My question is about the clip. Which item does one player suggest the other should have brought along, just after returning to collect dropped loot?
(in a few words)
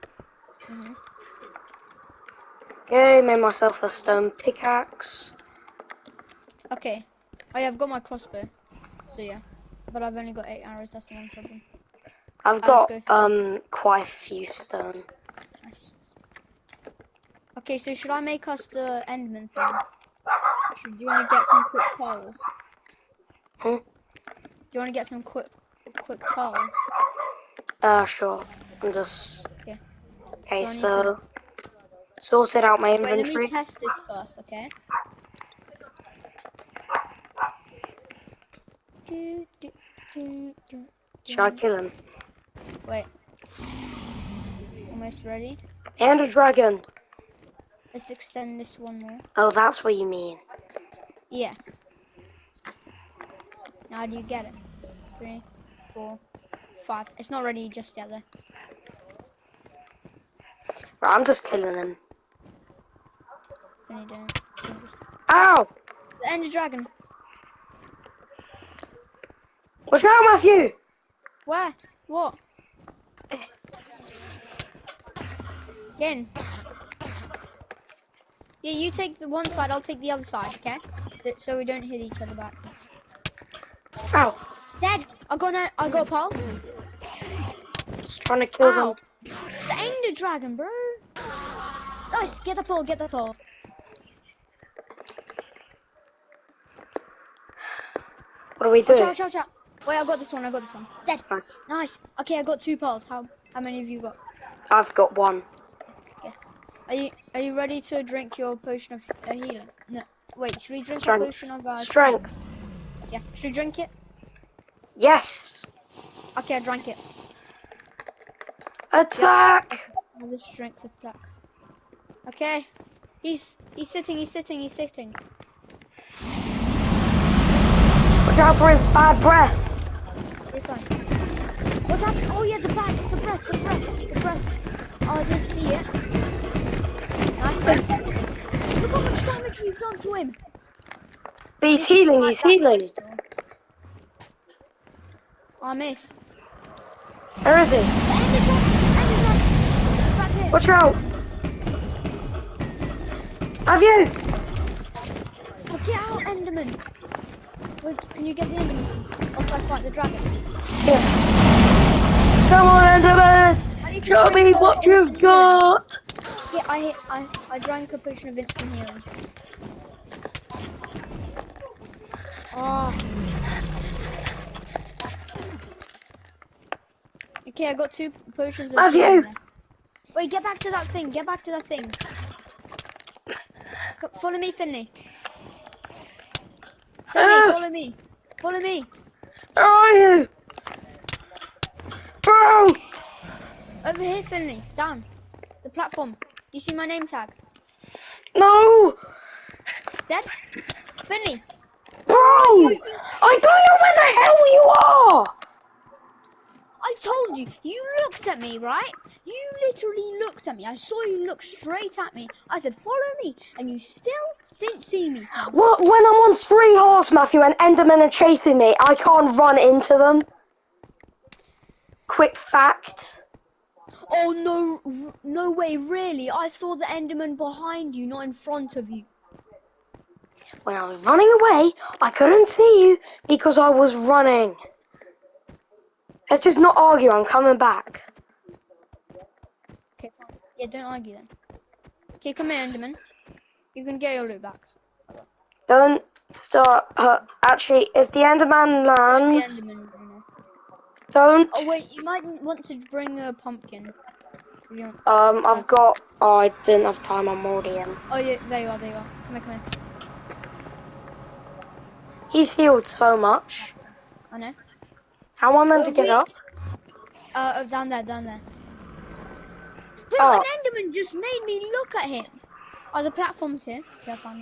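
a pumpkin.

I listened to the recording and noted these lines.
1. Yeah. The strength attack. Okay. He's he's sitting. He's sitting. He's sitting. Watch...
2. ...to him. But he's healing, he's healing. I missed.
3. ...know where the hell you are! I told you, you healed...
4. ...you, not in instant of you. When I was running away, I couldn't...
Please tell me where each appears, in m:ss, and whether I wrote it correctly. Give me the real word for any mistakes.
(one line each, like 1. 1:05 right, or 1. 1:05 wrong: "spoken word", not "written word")
1. 2:00 right
2. 2:19 right
3. 3:23 wrong: "looked", not "healed"
4. 3:47 wrong: "front", not "instant".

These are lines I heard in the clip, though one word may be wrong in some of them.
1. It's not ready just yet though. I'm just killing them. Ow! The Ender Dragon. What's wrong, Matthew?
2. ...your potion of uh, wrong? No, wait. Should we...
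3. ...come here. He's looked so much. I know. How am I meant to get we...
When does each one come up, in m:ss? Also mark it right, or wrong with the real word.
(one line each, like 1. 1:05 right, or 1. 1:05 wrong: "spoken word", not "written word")
1. 0:57 right
2. 1:48 wrong: "healing", not "wrong"
3. 4:19 wrong: "healed", not "looked".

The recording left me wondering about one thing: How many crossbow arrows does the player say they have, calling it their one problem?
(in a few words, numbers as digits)
8.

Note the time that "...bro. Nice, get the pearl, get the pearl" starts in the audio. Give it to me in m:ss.
1:30.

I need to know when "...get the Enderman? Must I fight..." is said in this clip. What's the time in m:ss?
2:38.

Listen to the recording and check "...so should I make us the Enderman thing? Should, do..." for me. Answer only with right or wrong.
right.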